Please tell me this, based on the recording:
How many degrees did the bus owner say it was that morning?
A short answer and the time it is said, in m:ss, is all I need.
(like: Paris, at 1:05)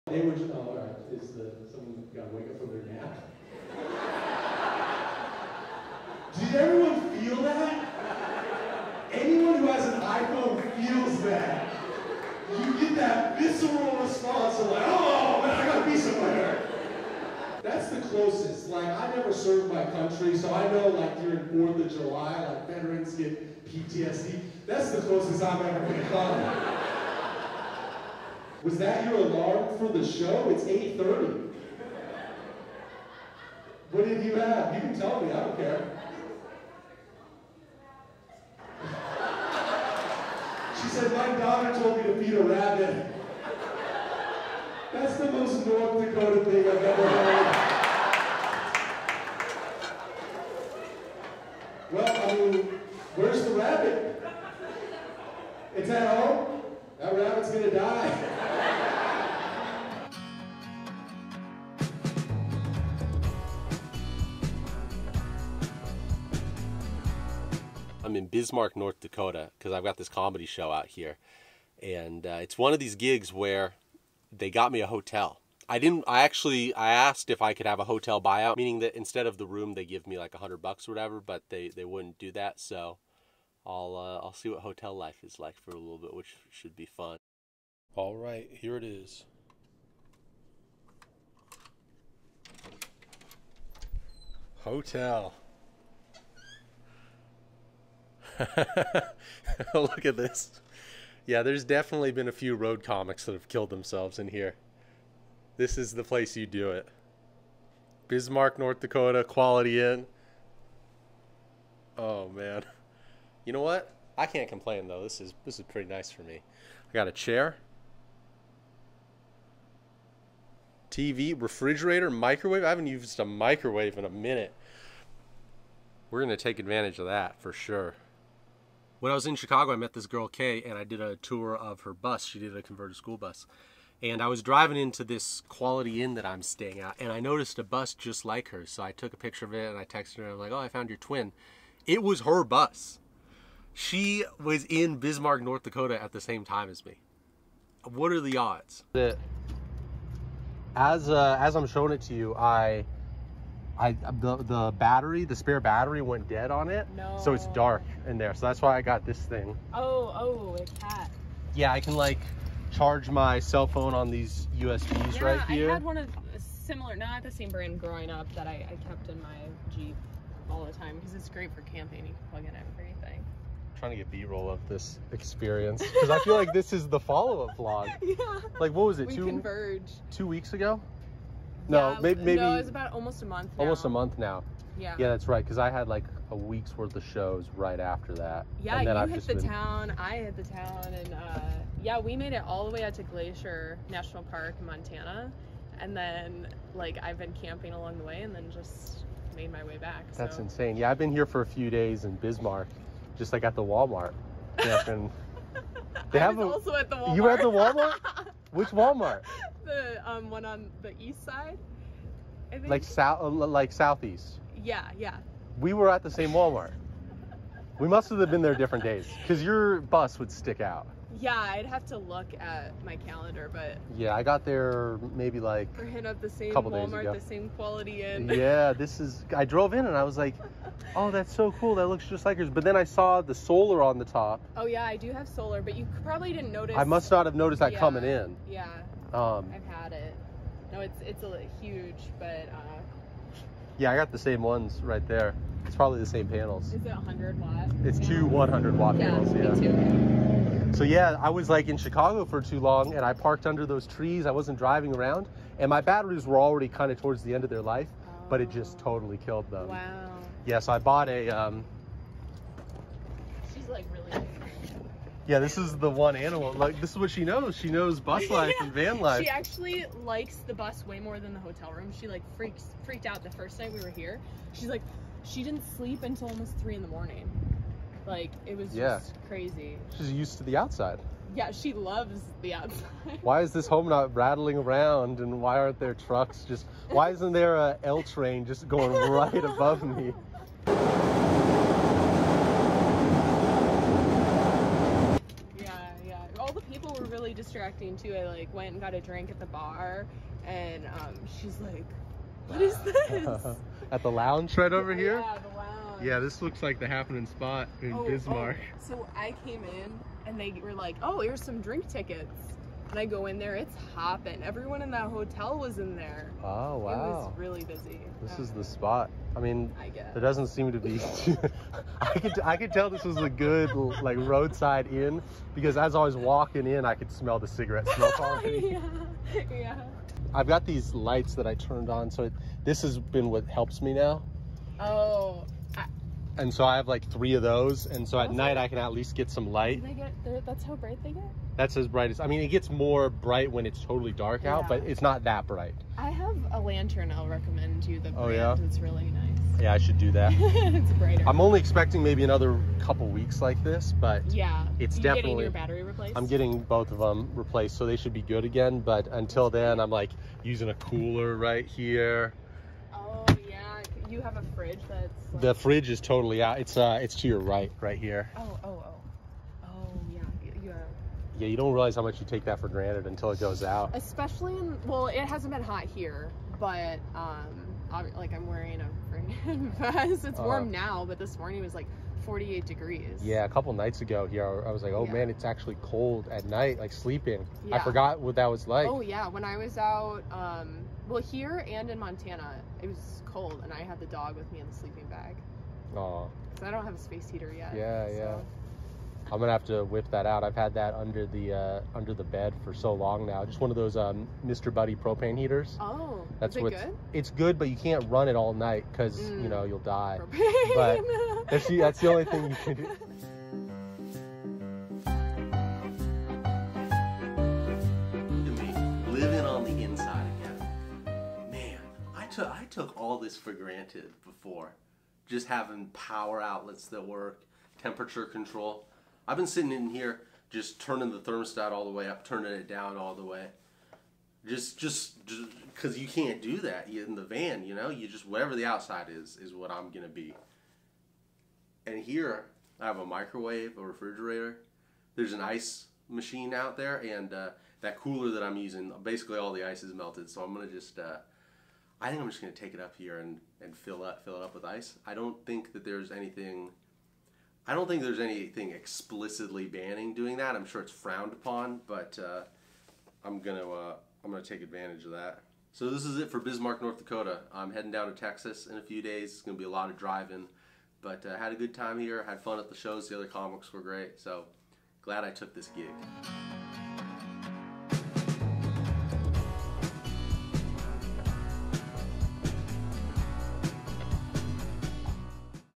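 48 degrees, at 6:22.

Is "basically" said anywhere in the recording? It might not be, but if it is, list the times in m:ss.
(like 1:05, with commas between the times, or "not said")
7:29.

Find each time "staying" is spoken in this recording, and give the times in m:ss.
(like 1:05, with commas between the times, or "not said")
2:16.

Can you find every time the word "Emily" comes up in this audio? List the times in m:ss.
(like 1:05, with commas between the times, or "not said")
not said.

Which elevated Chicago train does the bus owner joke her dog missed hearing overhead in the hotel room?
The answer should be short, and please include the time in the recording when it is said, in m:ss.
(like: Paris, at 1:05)
L train, at 4:47.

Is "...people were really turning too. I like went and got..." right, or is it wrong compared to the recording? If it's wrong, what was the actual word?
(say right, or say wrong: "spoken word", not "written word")
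wrong: "distracting", not "turning".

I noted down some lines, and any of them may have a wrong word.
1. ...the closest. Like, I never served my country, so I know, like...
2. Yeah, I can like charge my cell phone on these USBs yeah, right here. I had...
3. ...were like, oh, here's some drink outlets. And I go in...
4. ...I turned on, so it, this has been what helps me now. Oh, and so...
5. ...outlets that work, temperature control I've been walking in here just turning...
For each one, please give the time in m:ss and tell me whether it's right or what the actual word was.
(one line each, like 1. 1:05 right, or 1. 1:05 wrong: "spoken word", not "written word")
1. 0:17 right
2. 2:41 right
3. 5:10 wrong: "tickets", not "outlets"
4. 5:31 right
5. 7:06 wrong: "sitting", not "walking".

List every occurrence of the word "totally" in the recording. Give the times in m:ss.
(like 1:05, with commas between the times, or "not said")
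4:18, 5:43, 6:05.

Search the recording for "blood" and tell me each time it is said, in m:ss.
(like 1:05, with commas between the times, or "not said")
not said.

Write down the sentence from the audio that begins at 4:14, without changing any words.
I wasn't driving around, and my batteries were already kind of towards the end of their life, oh.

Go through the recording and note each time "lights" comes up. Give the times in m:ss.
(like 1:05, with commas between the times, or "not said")
5:30, 5:39.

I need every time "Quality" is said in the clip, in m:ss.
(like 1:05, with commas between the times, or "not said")
1:49, 2:15, 3:47.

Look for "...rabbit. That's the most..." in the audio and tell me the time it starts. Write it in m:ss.
0:42.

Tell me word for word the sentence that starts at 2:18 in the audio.
So I took a picture of it and I texted her, and I'm like, oh, I found your twin.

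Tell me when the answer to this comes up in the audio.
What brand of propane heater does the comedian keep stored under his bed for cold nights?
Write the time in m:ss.
6:44.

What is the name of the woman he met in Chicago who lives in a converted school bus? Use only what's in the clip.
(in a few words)
Kay.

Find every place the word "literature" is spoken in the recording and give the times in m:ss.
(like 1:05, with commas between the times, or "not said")
not said.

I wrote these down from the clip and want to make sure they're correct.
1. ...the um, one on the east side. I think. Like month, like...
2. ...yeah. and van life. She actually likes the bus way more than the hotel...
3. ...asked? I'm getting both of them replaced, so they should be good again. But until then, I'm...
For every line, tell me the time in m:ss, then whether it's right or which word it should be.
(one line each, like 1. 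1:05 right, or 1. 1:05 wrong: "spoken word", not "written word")
1. 3:29 wrong: "south", not "month"
2. 4:28 right
3. 5:55 wrong: "replaced", not "asked".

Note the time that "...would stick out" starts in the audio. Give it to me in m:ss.
3:40.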